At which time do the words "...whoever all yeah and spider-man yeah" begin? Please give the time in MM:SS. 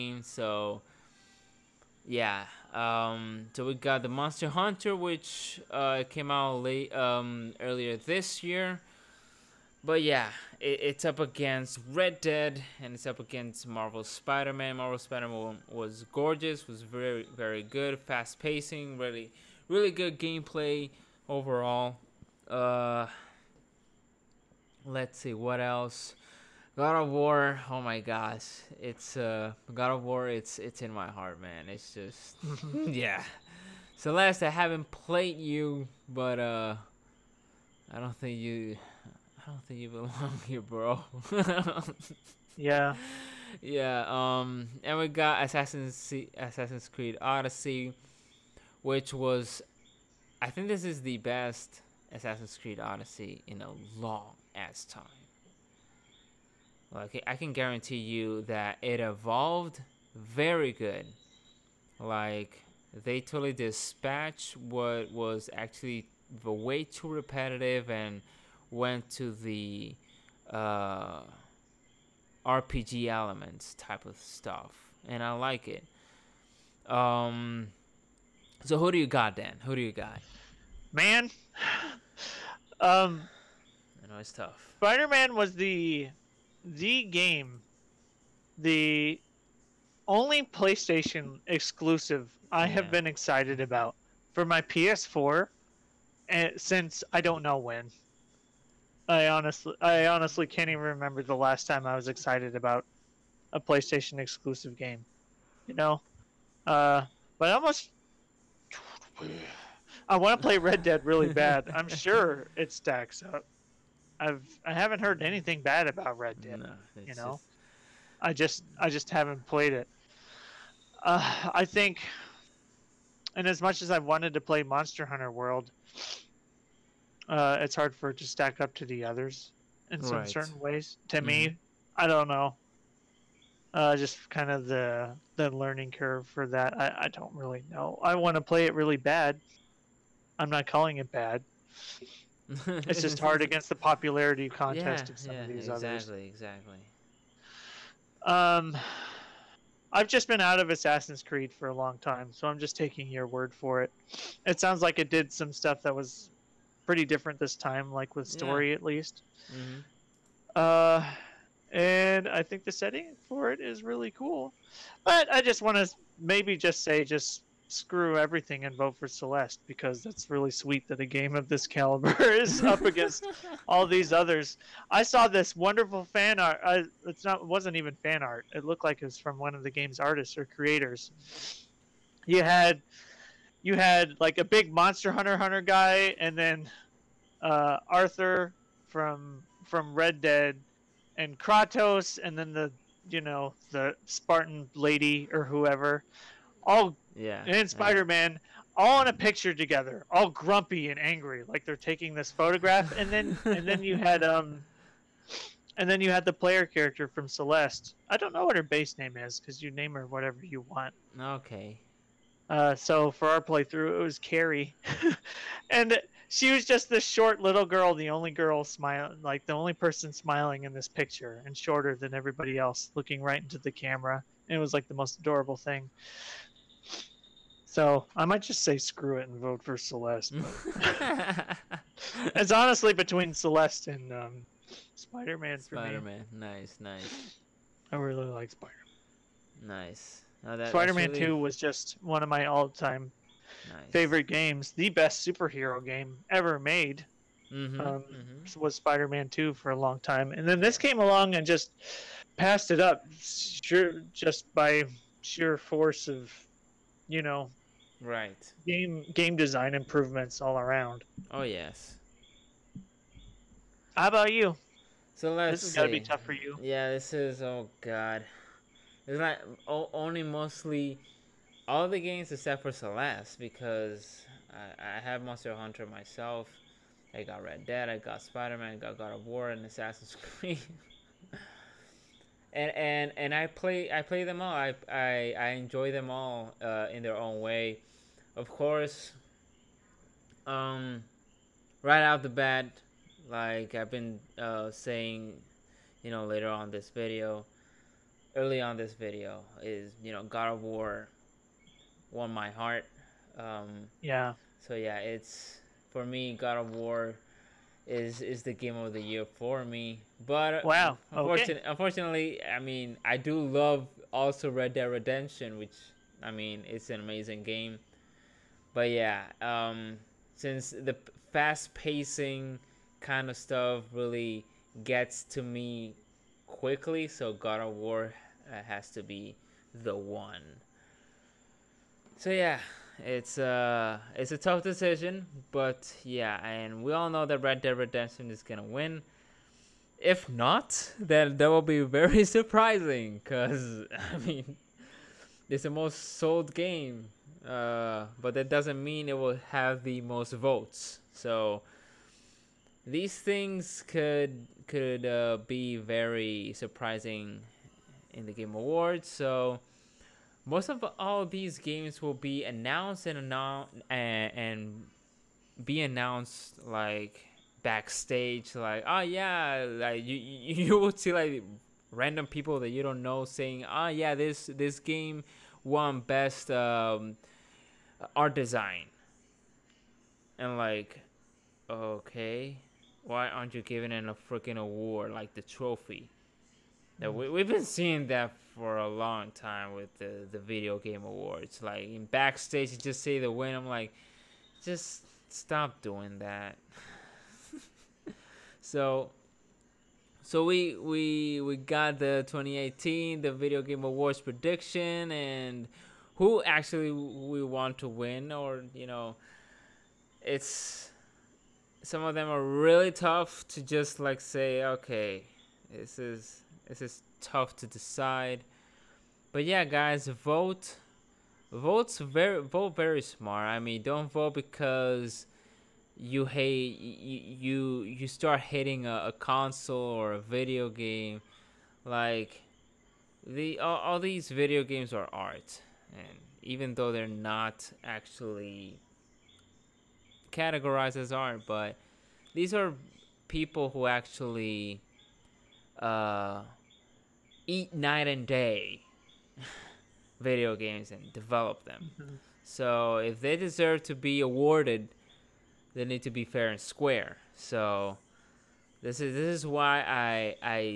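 03:15.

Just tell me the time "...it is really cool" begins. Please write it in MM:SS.
02:43.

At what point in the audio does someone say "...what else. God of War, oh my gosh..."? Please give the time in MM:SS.
00:25.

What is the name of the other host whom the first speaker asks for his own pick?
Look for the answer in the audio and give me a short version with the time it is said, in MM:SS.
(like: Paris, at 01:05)
Dan, at 01:19.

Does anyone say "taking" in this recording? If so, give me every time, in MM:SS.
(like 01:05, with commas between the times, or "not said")
02:32, 03:21.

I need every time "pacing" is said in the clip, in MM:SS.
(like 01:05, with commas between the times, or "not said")
00:18, 05:21.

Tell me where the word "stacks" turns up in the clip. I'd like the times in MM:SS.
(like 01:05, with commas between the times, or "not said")
01:52, 02:08.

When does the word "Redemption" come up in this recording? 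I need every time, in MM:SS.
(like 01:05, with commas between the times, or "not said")
05:14, 05:37.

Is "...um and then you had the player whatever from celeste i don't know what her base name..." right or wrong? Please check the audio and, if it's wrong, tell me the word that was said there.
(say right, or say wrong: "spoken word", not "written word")
wrong: "character", not "whatever".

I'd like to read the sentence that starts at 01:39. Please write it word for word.
I honestly, I honestly can't even remember the last time I was excited about a PlayStation exclusive game.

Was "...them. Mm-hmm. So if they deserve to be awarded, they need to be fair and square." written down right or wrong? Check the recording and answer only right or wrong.
right.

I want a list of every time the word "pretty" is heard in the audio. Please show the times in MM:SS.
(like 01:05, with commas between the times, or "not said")
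02:36.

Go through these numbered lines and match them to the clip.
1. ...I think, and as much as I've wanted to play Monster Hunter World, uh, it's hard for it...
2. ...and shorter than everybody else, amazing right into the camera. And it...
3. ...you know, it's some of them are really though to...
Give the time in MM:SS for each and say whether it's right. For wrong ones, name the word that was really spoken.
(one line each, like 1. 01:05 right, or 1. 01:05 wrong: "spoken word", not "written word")
1. 02:01 right
2. 03:41 wrong: "looking", not "amazing"
3. 06:48 wrong: "tough", not "though".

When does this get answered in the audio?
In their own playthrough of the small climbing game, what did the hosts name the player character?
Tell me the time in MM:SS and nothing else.
03:34.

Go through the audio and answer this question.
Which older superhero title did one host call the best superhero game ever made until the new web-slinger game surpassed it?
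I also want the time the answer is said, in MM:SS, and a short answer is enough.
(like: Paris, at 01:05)
Spider-Man 2, at 04:08.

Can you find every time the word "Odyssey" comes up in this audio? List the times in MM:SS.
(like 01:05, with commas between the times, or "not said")
00:47, 00:52.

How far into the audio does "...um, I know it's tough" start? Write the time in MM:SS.
01:22.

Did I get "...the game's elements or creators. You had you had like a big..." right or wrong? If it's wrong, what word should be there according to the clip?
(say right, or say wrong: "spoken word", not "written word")
wrong: "artists", not "elements".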